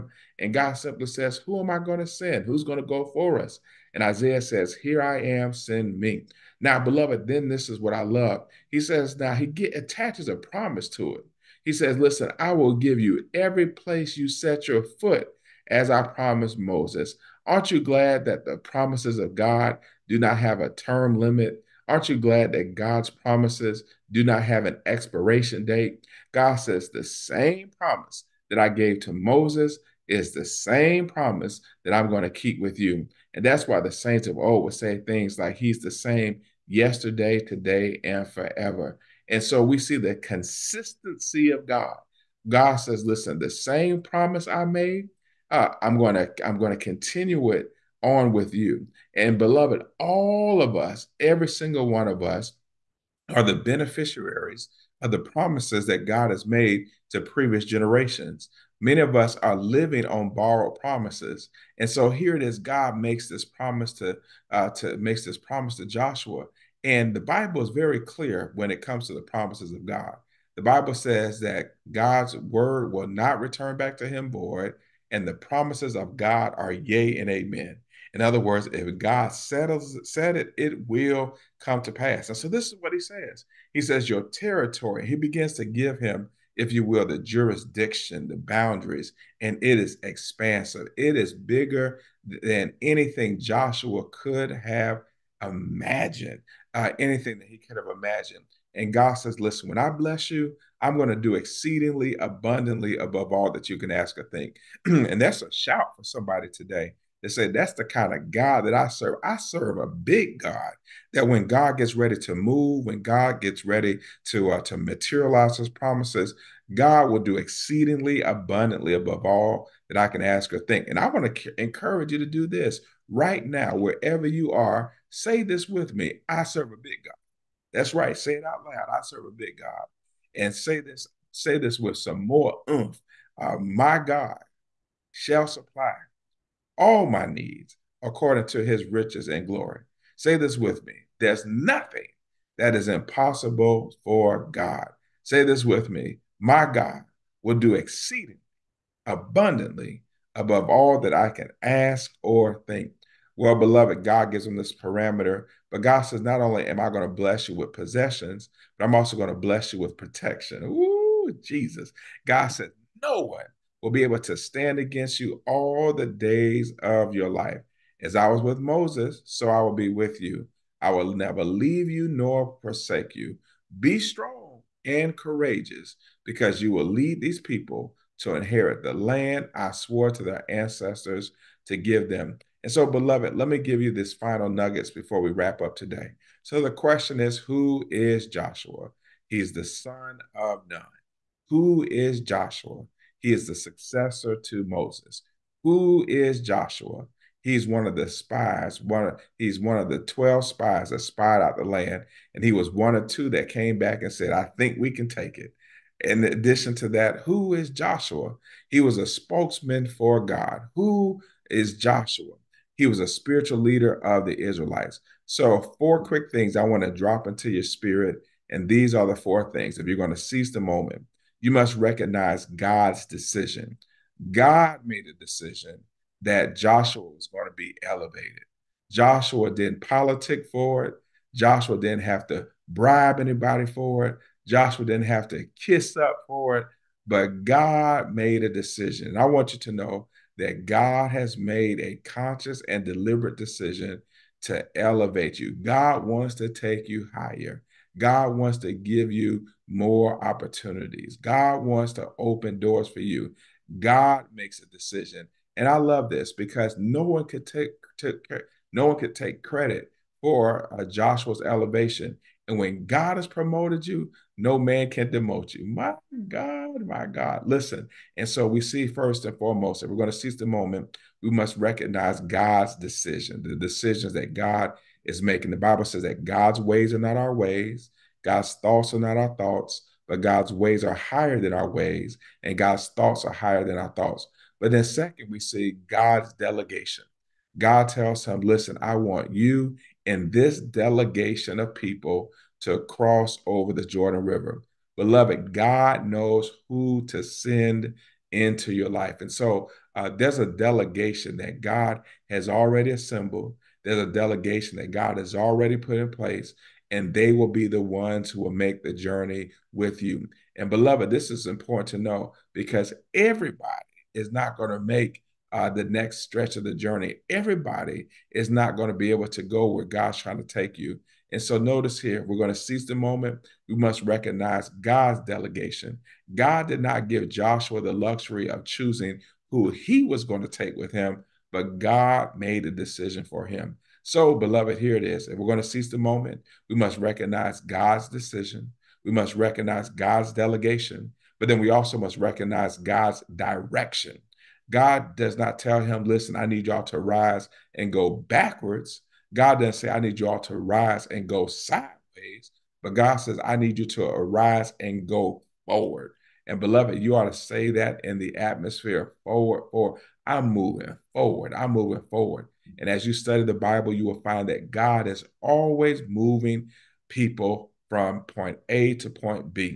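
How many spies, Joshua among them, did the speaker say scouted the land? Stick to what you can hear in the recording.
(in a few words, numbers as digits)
12.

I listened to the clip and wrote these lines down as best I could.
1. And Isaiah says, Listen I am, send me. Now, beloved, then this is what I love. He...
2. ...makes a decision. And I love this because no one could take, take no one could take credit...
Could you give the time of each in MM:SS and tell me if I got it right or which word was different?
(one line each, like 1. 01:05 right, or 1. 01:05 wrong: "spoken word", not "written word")
1. 00:03 wrong: "Here", not "Listen"
2. 04:14 right.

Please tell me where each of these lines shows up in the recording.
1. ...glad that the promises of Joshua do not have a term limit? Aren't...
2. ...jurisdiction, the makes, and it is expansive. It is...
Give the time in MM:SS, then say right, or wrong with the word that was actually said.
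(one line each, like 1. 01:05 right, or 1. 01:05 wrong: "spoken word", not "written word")
1. 00:17 wrong: "God", not "Joshua"
2. 01:27 wrong: "boundaries", not "makes".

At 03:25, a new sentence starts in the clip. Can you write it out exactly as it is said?
In addition to that, who is Joshua?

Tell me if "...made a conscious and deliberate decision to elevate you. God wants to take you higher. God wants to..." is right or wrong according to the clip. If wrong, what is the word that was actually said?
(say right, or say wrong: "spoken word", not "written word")
right.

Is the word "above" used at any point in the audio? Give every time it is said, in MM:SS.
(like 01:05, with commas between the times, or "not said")
01:42, 01:58, 02:30.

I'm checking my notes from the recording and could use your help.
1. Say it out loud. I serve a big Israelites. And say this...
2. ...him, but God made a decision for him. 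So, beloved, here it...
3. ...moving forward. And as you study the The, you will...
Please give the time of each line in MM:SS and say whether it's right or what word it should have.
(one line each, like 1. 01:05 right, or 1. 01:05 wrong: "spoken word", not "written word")
1. 02:08 wrong: "God", not "Israelites"
2. 05:30 right
3. 06:01 wrong: "Bible", not "The".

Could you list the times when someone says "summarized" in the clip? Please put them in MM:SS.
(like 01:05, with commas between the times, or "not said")
not said.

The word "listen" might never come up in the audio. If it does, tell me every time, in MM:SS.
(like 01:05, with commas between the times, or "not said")
00:11, 00:43, 01:39, 04:27, 04:48, 05:46.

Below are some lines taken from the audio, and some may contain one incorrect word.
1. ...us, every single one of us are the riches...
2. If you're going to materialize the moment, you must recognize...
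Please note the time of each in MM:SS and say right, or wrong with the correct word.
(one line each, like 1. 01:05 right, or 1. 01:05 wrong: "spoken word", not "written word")
1. 00:50 wrong: "beneficiaries", not "riches"
2. 03:39 wrong: "seize", not "materialize".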